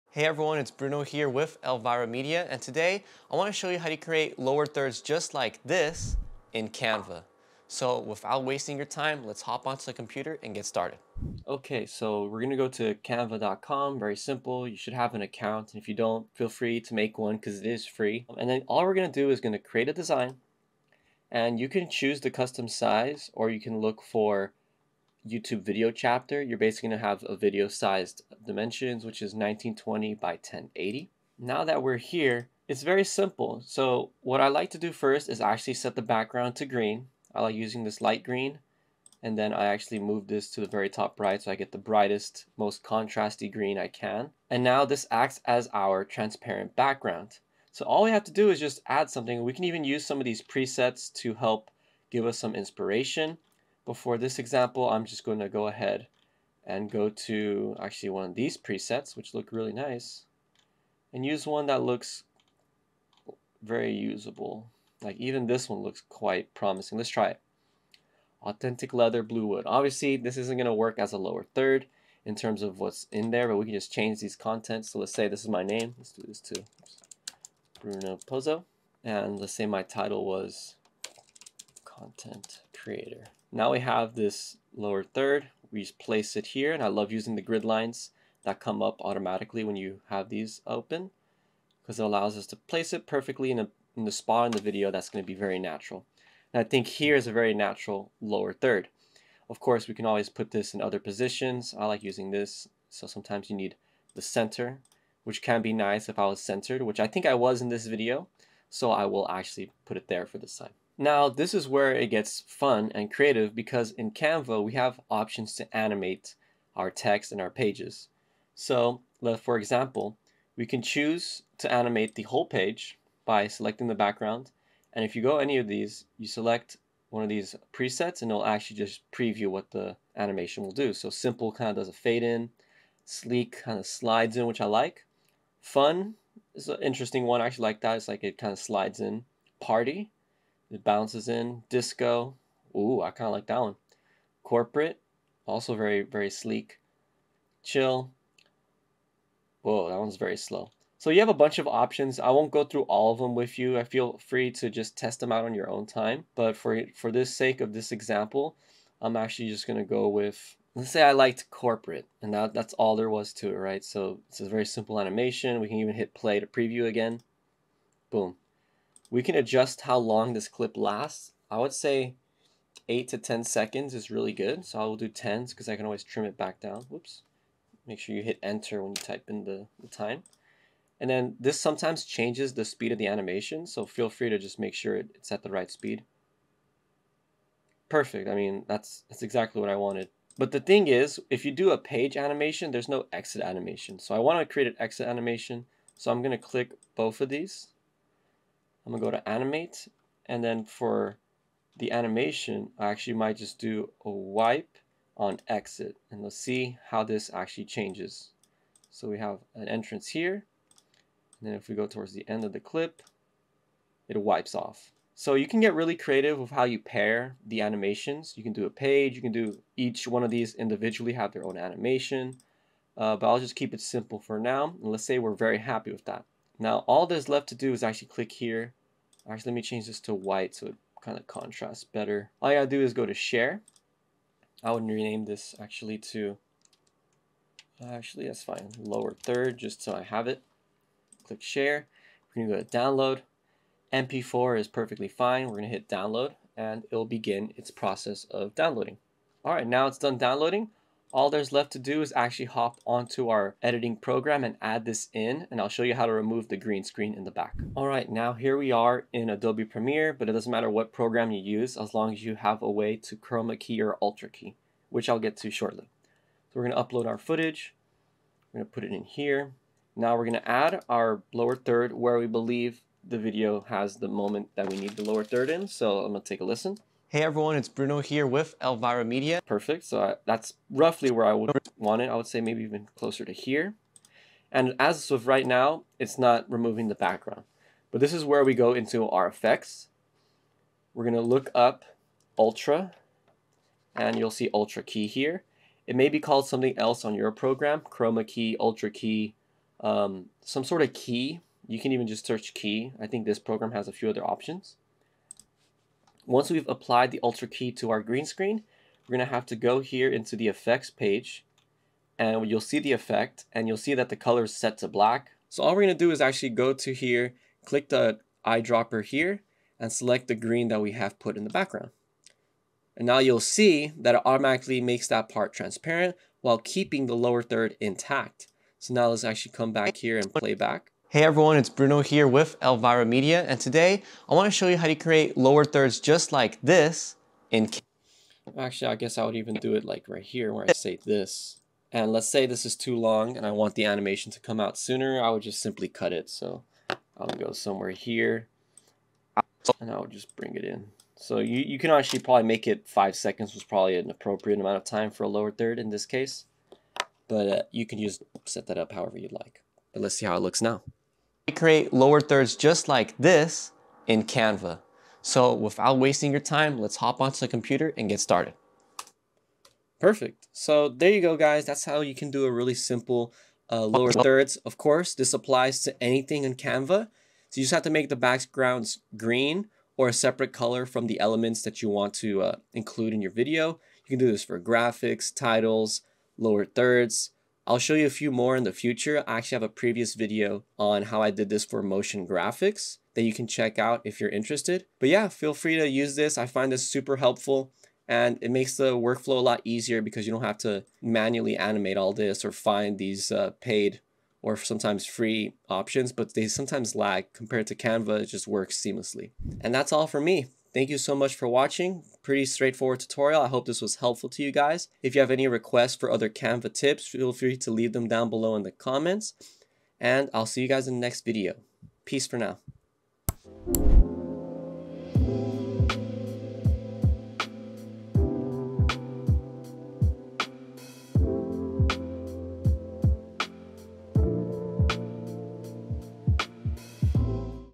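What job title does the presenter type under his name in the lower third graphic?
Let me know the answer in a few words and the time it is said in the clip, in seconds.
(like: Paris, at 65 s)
Content creator, at 82 s.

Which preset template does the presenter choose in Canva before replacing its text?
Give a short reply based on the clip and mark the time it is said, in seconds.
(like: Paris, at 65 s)
Authentic leather blue wood, at 68 s.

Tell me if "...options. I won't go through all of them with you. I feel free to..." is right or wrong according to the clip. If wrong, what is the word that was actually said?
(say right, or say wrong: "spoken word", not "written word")
right.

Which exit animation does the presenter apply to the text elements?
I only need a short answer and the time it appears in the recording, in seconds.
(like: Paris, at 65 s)
Wipe, at 204 s.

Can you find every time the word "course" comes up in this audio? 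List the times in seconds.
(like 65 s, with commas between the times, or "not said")
99 s, 374 s.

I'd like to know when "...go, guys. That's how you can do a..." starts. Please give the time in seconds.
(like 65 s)
371 s.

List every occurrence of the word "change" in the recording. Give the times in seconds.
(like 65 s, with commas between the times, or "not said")
73 s, 182 s, 207 s, 229 s.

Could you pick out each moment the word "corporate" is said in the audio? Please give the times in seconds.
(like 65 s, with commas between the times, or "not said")
144 s, 161 s.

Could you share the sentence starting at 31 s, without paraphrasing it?
Now that we're here, it's very simple.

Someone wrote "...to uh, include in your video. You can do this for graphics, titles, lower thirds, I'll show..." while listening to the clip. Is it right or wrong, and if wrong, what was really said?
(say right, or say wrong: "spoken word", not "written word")
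right.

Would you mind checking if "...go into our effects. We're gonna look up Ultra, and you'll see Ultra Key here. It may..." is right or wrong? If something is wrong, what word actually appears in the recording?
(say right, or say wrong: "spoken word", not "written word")
right.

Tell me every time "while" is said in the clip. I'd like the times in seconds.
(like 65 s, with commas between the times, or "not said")
326 s.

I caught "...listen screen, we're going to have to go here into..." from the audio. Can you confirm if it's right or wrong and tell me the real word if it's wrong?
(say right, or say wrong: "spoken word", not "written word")
wrong: "green", not "listen".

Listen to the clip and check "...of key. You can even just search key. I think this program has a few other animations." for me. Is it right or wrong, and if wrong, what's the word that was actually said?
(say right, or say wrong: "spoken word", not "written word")
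wrong: "options", not "animations".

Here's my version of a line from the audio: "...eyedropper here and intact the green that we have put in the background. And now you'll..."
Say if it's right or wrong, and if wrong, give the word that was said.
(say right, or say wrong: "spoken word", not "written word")
wrong: "select", not "intact".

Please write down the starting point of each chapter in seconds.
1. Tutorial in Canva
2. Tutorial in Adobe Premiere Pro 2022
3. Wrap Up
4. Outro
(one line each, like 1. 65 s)
1. 11 s
2. 257 s
3. 409 s
4. 422 s.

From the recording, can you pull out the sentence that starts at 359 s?
But let's see how it looks now create lower thirds just like this in Canva.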